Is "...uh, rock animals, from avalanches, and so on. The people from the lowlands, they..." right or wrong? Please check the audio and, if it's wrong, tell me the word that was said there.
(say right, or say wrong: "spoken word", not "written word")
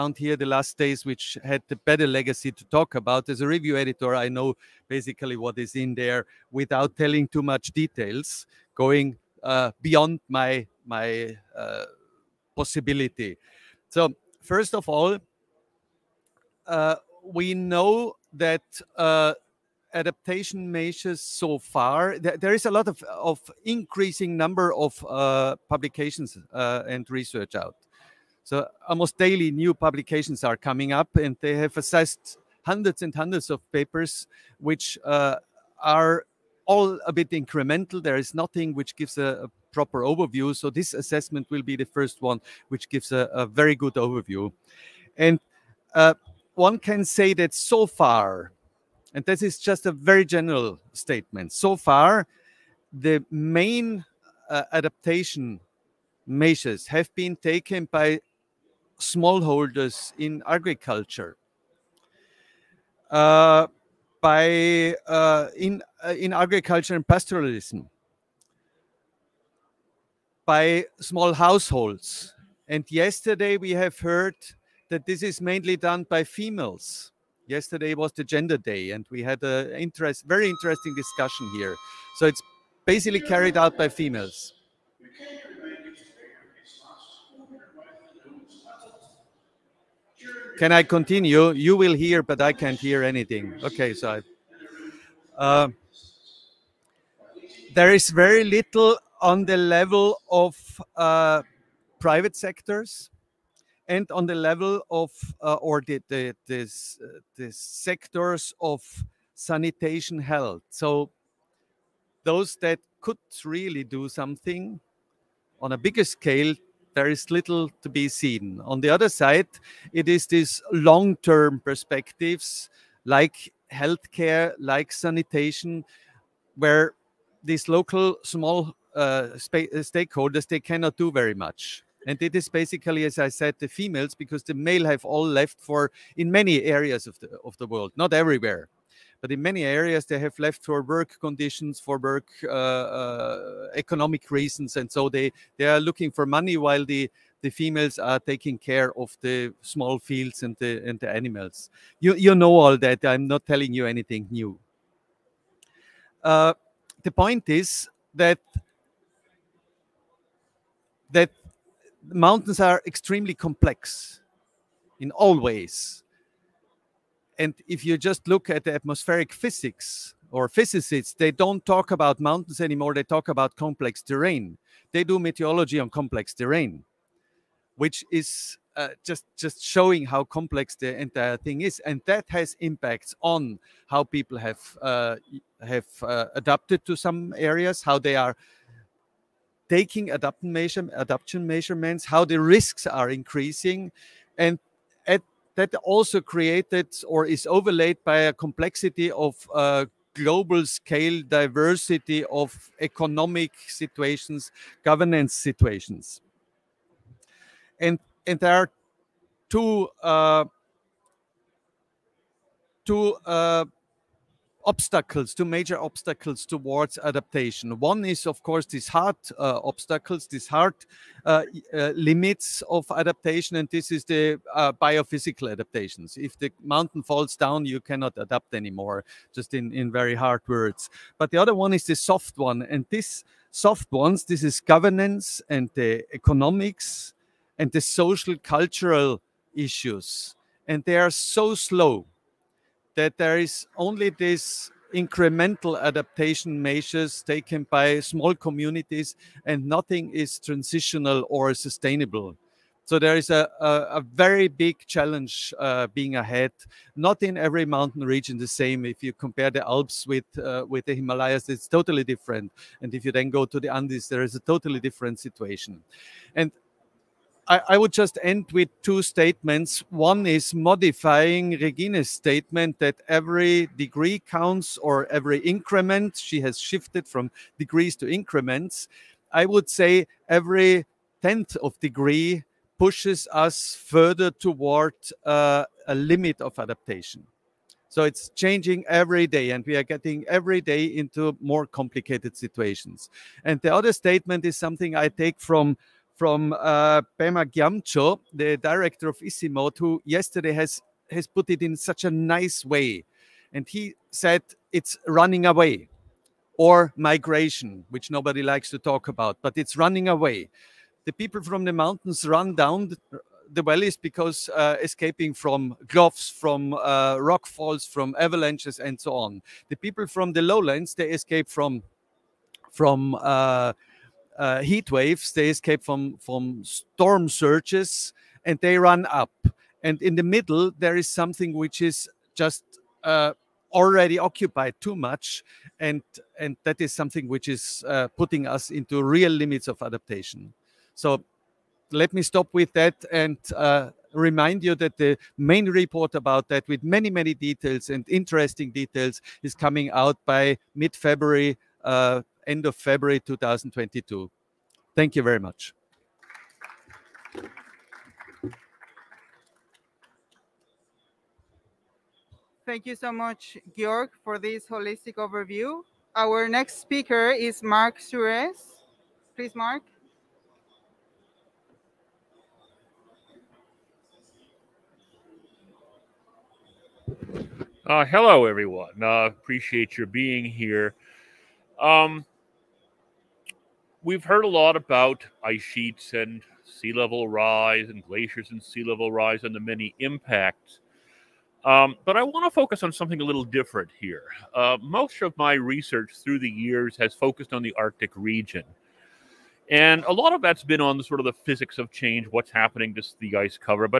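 wrong: "falls", not "animals".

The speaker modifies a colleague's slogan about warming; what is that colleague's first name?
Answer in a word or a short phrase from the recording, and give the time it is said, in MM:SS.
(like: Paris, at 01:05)
Regina, at 04:31.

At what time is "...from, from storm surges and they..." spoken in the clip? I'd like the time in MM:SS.
05:25.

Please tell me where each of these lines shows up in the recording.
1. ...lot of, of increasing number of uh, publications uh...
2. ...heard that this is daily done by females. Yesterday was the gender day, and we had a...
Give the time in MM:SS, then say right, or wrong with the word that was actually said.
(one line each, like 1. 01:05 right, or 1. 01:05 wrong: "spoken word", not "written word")
1. 00:22 right
2. 01:14 wrong: "mainly", not "daily".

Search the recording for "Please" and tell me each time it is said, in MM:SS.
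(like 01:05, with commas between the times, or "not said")
06:09.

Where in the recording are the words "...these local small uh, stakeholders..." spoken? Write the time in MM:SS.
02:07.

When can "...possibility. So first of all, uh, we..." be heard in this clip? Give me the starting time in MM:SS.
00:12.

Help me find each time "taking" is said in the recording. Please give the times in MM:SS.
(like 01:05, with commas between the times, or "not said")
02:28, 03:09.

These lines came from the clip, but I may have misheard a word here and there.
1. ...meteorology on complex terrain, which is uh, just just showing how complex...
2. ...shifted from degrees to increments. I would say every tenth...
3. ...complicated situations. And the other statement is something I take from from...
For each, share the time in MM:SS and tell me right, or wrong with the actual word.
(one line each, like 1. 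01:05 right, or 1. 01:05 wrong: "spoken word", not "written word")
1. 02:55 right
2. 04:36 right
3. 04:51 right.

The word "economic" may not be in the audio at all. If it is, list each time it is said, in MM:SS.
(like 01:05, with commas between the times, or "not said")
02:23, 03:22, 03:56.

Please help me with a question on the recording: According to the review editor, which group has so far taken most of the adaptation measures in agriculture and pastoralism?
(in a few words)
smallholders.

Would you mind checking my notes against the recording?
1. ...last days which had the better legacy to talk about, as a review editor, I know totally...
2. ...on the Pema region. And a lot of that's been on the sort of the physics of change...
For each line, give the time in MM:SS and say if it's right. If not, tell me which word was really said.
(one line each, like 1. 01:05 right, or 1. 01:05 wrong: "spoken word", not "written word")
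1. 00:00 wrong: "basically", not "totally"
2. 06:37 wrong: "Arctic", not "Pema".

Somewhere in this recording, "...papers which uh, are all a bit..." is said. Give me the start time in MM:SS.
00:33.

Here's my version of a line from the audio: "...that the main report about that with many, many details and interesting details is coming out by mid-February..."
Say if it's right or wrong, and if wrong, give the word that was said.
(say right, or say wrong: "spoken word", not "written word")
right.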